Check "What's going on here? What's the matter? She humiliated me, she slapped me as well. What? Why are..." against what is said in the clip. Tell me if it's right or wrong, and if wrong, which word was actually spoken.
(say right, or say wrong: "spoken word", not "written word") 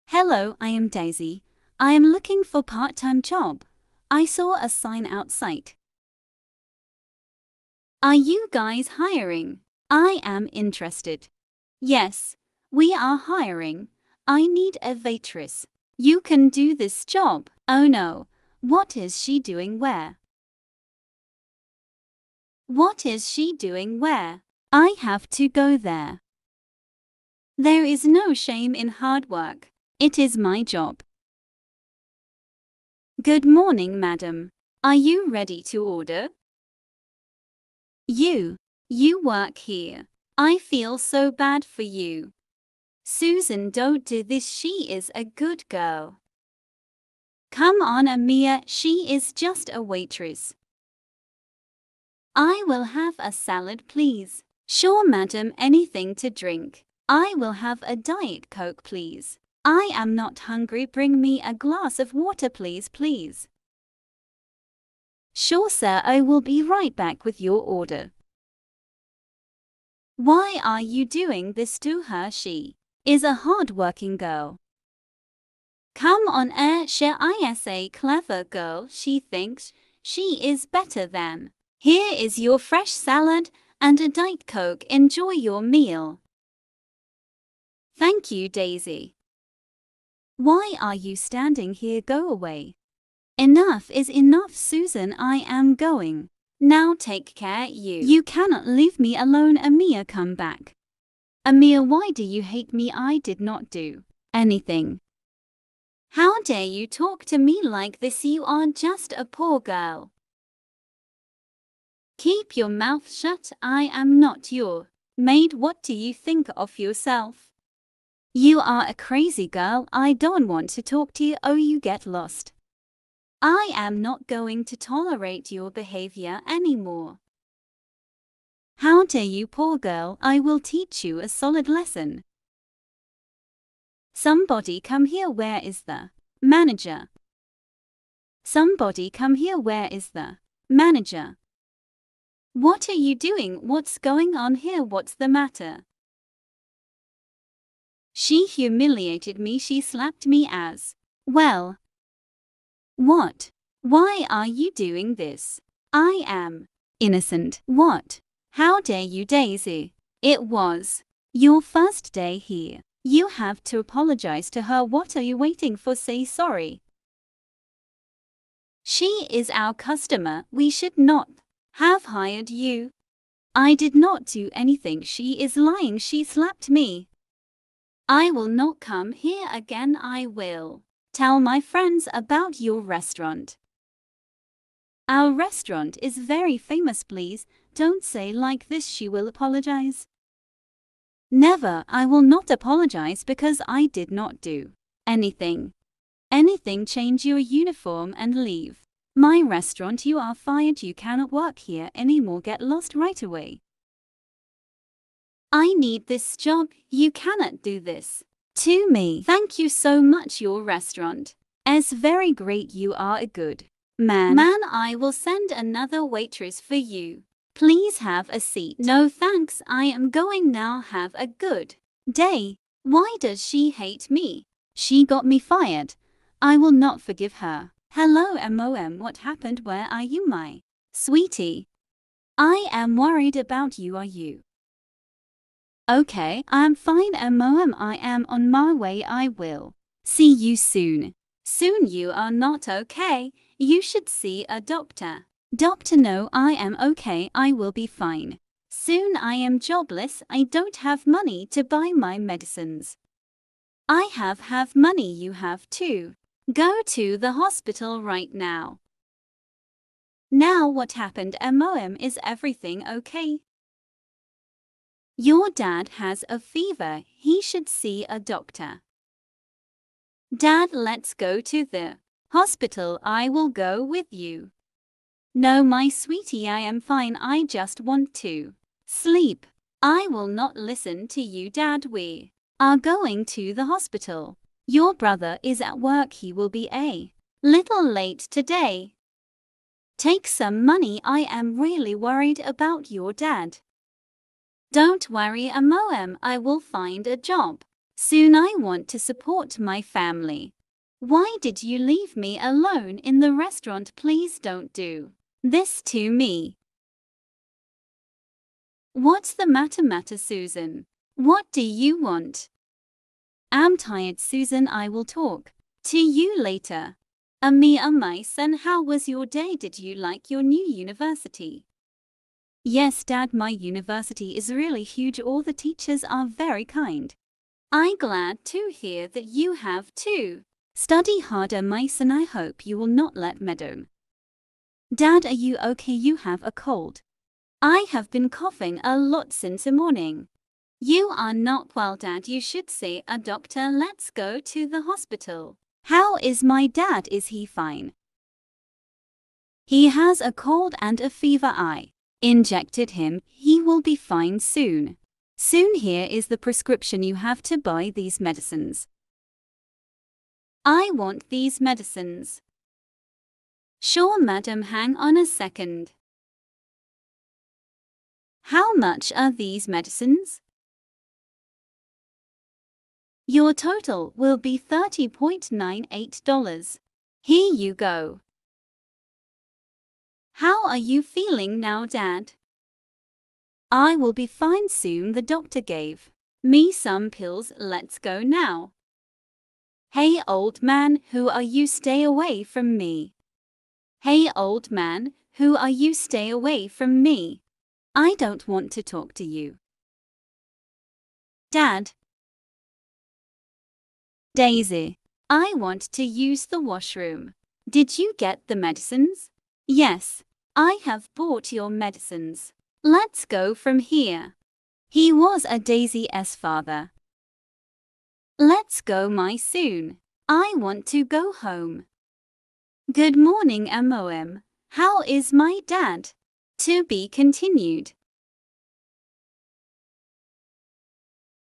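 right.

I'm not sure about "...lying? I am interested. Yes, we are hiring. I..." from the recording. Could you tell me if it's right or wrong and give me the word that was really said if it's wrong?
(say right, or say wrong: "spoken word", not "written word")
wrong: "hiring", not "lying".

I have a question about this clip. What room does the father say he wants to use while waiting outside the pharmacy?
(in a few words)
Washroom.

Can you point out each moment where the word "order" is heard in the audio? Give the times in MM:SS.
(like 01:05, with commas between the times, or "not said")
00:35, 01:07.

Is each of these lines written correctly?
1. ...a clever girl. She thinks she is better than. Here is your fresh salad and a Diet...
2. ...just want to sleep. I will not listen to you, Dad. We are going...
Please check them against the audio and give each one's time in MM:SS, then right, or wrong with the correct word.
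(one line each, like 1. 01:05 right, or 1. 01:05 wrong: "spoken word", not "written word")
1. 01:17 right
2. 04:37 right.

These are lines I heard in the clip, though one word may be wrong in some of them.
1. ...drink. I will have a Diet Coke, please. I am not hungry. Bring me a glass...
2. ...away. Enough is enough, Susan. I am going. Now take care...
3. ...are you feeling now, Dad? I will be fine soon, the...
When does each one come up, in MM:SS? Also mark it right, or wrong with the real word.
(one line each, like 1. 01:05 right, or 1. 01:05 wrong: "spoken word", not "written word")
1. 00:56 right
2. 01:32 right
3. 06:20 right.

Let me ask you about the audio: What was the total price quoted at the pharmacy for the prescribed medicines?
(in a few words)
$30.98.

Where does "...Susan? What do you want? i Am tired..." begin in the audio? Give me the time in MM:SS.
05:10.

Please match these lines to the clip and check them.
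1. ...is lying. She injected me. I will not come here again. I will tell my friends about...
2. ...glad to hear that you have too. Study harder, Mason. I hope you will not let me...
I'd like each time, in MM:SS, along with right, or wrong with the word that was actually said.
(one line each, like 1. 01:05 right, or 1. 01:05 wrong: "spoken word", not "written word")
1. 02:55 wrong: "slapped", not "injected"
2. 05:27 right.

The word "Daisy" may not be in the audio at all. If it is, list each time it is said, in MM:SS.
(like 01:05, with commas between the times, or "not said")
00:00, 01:28, 02:39, 06:44, 06:55.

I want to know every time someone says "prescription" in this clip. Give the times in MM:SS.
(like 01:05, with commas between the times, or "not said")
05:56.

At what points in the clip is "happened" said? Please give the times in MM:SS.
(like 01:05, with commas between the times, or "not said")
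03:49, 04:20.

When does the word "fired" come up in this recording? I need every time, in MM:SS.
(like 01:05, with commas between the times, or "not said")
03:20, 03:45.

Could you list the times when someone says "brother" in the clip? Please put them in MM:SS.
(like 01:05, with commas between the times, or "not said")
04:44.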